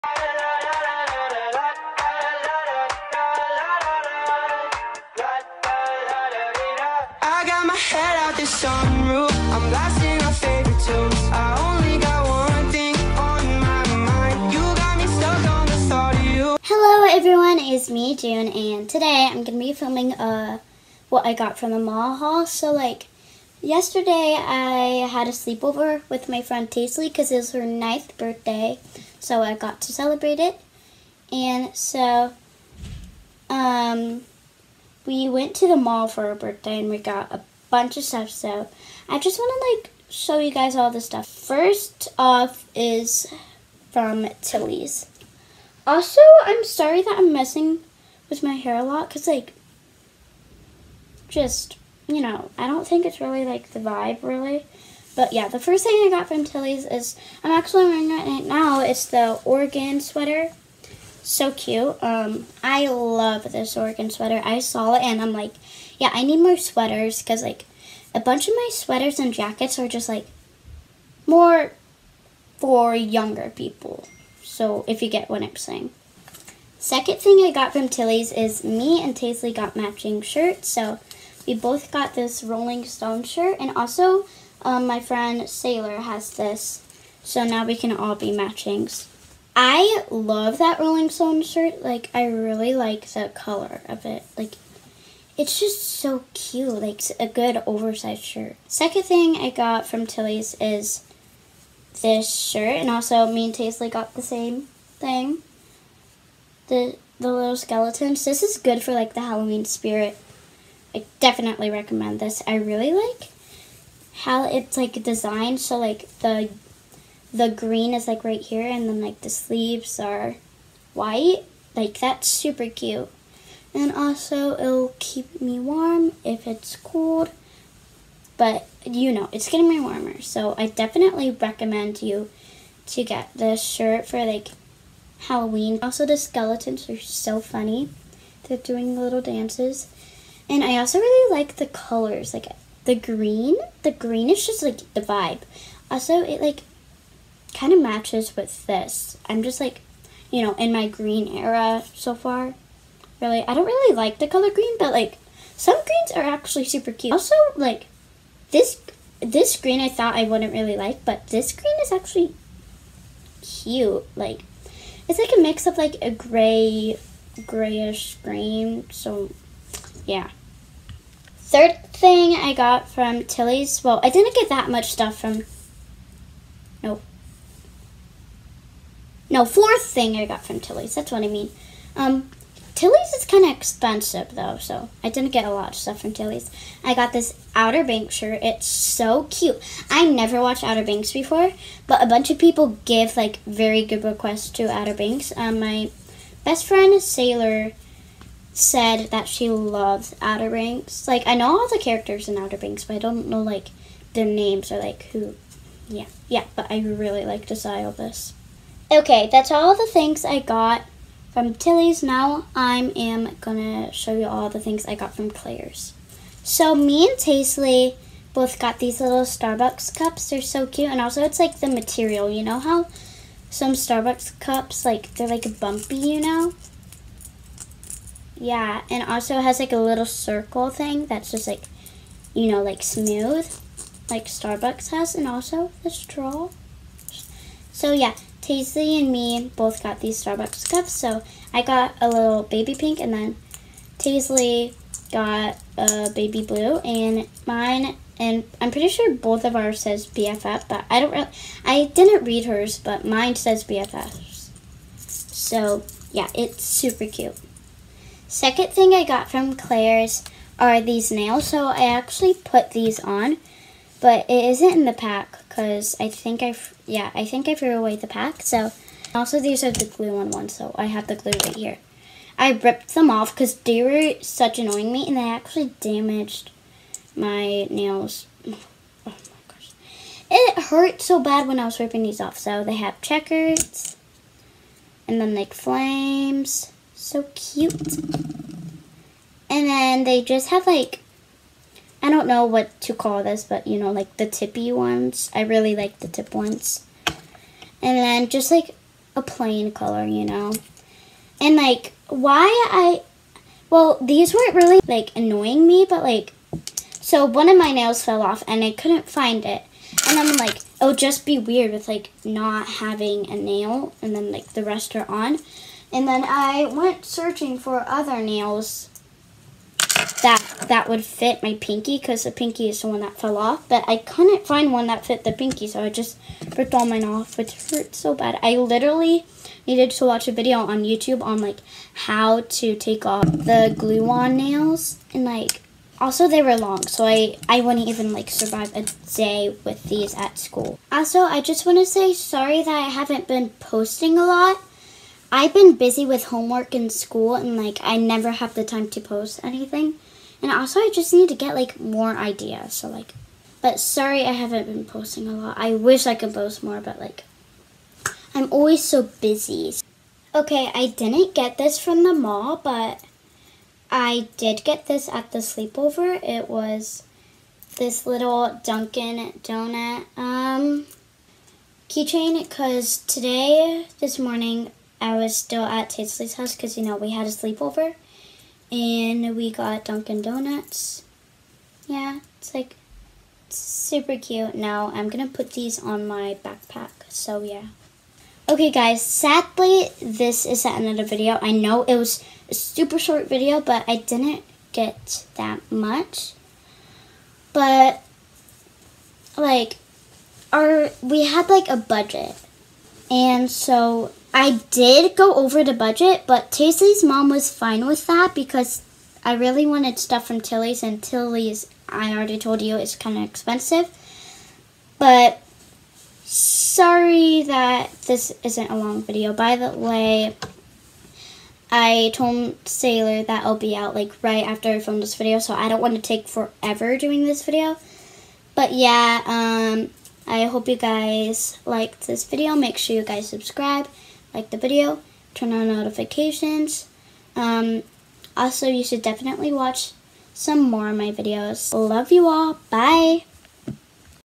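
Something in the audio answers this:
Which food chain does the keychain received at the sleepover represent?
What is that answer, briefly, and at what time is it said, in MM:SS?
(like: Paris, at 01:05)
Dunkin' Donuts, at 06:08.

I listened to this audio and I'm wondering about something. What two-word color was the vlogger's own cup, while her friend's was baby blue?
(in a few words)
Baby pink.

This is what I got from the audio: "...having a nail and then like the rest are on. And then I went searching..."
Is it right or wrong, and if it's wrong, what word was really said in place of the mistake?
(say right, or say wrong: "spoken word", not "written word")
right.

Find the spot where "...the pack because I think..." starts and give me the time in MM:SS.
04:24.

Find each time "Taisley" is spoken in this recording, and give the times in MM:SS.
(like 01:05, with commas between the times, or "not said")
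00:26, 01:19, 03:37, 03:58, 04:03, 06:46.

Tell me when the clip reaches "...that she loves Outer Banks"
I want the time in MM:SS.
03:19.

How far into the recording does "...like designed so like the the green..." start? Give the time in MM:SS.
01:54.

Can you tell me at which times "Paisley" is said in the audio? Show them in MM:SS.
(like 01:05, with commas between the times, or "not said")
01:43.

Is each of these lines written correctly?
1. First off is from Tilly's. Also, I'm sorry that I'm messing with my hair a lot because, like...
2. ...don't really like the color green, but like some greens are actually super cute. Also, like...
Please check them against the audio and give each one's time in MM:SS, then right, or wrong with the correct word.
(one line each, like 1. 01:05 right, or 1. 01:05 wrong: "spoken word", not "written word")
1. 00:41 right
2. 02:33 right.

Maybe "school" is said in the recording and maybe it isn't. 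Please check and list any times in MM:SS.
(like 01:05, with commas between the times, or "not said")
05:40, 05:46.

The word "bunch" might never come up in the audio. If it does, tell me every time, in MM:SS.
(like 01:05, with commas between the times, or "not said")
00:37, 01:08, 03:12.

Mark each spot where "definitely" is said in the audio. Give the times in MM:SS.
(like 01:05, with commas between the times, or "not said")
01:51, 02:10, 07:19.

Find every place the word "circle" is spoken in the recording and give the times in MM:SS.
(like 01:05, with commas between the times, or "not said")
03:50.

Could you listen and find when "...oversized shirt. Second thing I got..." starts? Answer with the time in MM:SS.
01:37.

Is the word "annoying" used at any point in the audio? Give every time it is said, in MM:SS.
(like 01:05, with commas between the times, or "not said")
04:34, 05:05.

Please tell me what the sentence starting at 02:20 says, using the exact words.
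And I also really like the colors, like the green.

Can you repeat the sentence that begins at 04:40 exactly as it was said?
It hurt so bad when I was ripping these off.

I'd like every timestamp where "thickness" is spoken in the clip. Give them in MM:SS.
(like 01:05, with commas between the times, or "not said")
not said.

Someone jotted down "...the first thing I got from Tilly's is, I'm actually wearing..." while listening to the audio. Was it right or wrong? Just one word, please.
right.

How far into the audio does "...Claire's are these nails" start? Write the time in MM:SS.
04:19.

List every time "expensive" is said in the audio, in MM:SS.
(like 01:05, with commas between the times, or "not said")
03:03, 06:53.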